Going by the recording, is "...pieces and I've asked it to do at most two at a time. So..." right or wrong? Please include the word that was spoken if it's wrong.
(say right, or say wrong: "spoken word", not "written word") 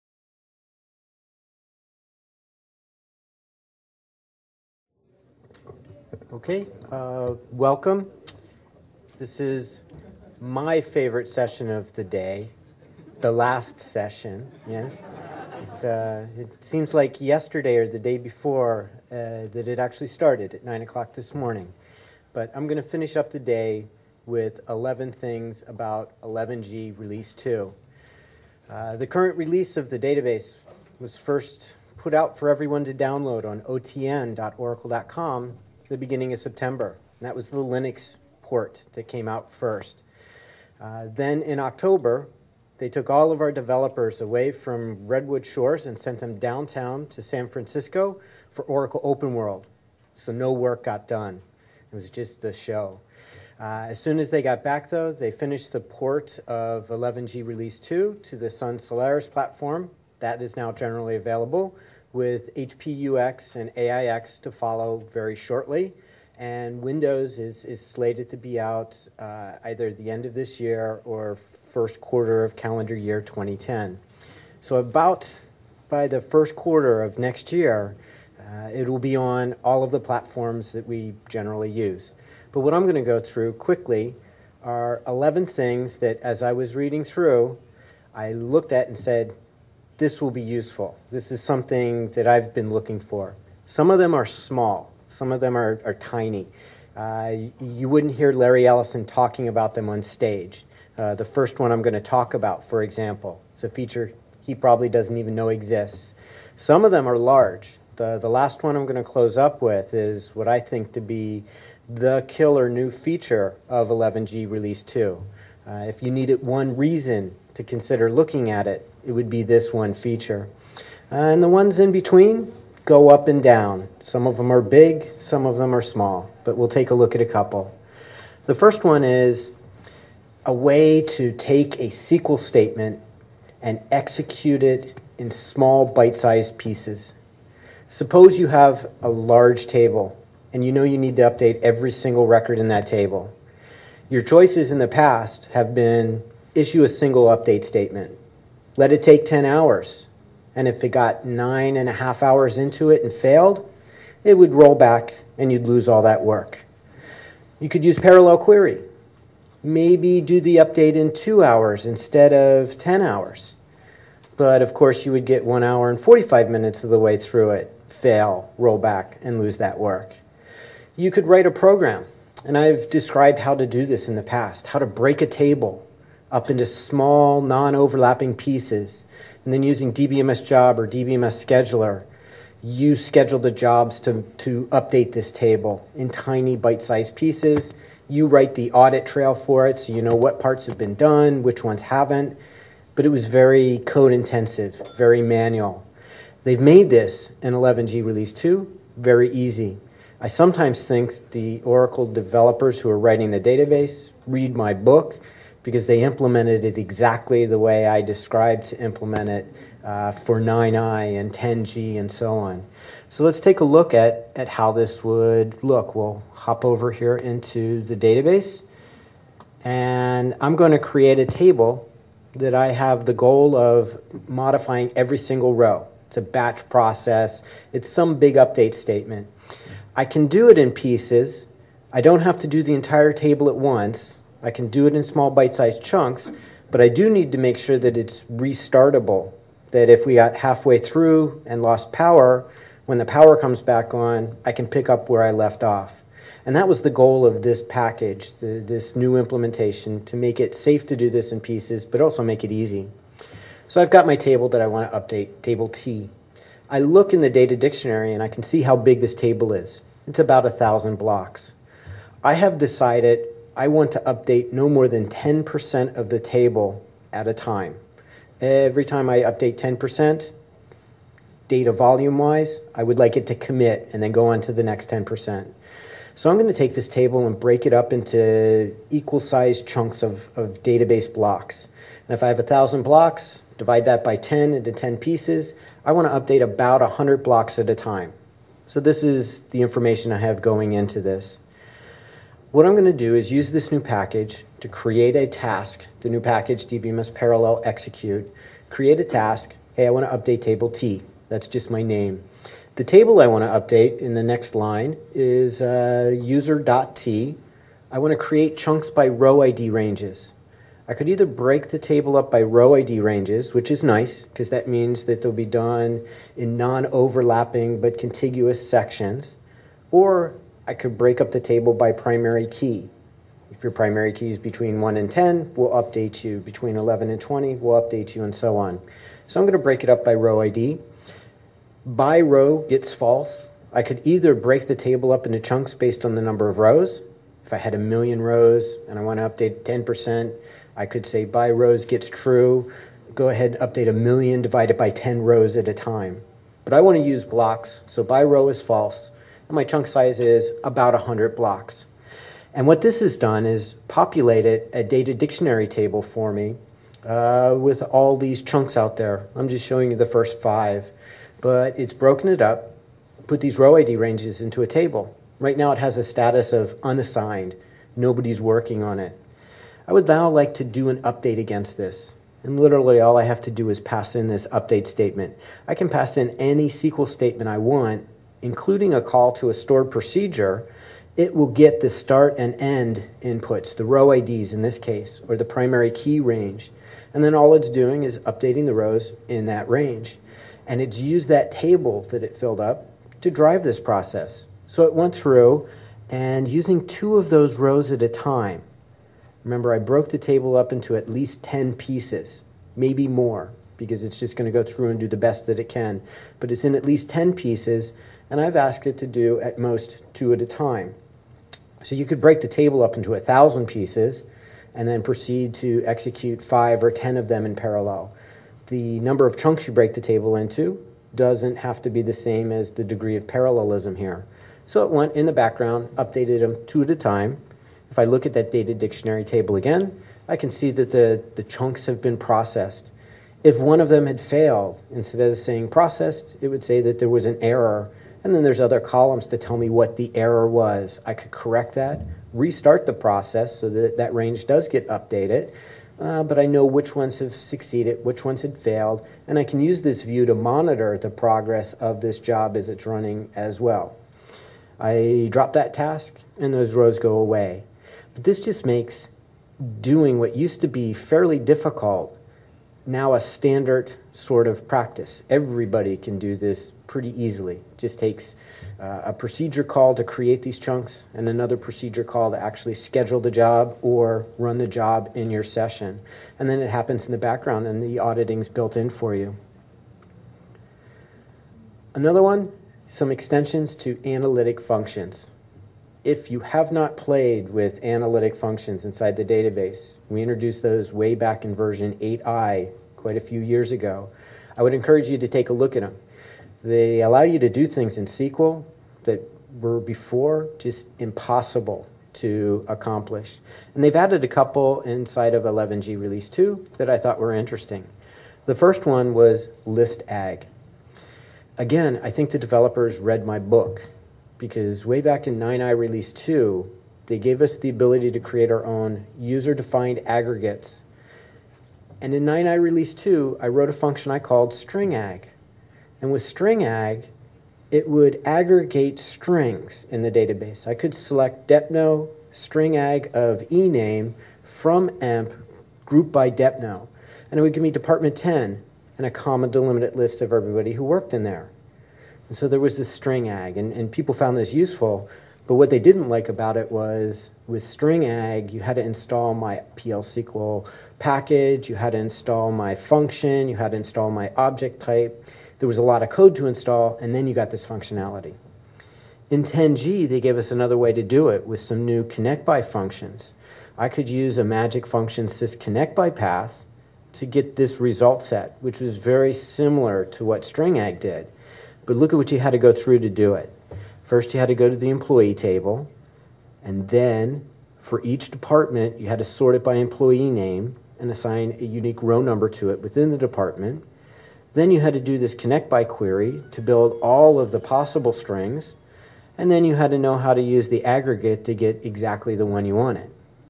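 right.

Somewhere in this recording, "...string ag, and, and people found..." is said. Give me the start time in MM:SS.
09:02.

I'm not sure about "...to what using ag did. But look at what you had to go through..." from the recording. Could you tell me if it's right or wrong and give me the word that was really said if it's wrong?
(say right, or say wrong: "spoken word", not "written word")
wrong: "string", not "using".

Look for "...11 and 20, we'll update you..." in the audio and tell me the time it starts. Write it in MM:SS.
05:26.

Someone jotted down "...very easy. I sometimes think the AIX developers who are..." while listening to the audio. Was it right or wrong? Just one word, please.
wrong.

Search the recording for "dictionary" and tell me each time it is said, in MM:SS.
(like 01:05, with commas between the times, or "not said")
04:17, 05:55, 07:08.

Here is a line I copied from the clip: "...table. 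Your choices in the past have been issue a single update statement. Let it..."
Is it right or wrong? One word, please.
right.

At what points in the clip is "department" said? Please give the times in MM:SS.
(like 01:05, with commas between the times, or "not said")
08:57, 09:38, 09:43.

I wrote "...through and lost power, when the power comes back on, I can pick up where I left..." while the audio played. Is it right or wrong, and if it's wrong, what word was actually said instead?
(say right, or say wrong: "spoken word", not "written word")
right.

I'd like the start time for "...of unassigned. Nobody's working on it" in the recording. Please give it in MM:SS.
06:06.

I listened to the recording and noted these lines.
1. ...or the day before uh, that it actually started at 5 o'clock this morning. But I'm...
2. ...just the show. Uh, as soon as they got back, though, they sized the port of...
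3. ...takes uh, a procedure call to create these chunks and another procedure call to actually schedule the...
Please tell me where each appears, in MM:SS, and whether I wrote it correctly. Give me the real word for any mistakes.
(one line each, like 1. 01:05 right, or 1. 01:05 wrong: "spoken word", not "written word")
1. 00:17 wrong: "9", not "5"
2. 00:52 wrong: "finished", not "sized"
3. 07:47 right.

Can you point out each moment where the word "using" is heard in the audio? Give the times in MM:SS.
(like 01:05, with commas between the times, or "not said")
02:59, 06:36.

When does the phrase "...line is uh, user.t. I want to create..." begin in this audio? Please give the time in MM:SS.
05:04.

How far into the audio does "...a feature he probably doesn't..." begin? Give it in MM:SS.
01:43.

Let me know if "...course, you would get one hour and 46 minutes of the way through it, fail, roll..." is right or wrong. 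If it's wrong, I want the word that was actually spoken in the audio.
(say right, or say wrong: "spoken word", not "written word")
wrong: "45", not "46".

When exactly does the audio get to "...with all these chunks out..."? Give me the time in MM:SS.
05:57.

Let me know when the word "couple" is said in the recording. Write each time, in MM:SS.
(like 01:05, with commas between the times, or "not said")
02:07, 08:24.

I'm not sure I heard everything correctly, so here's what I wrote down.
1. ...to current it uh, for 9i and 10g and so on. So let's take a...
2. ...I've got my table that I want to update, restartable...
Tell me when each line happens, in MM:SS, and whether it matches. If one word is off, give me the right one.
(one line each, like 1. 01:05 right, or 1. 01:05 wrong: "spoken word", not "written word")
1. 03:28 wrong: "implement", not "current"
2. 04:13 wrong: "table", not "restartable".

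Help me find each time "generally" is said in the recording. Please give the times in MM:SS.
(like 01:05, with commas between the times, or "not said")
01:00, 01:21.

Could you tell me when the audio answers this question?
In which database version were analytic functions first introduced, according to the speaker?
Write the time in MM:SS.
08:11.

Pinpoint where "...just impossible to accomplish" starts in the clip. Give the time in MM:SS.
08:20.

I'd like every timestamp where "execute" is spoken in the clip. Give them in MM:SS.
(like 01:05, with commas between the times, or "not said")
02:13, 04:57, 06:55.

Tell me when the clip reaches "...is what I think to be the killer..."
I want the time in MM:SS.
01:49.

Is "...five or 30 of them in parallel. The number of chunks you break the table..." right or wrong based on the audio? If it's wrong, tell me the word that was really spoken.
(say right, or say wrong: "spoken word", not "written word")
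wrong: "10", not "30".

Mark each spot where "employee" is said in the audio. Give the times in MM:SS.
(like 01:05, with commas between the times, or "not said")
09:34, 09:39.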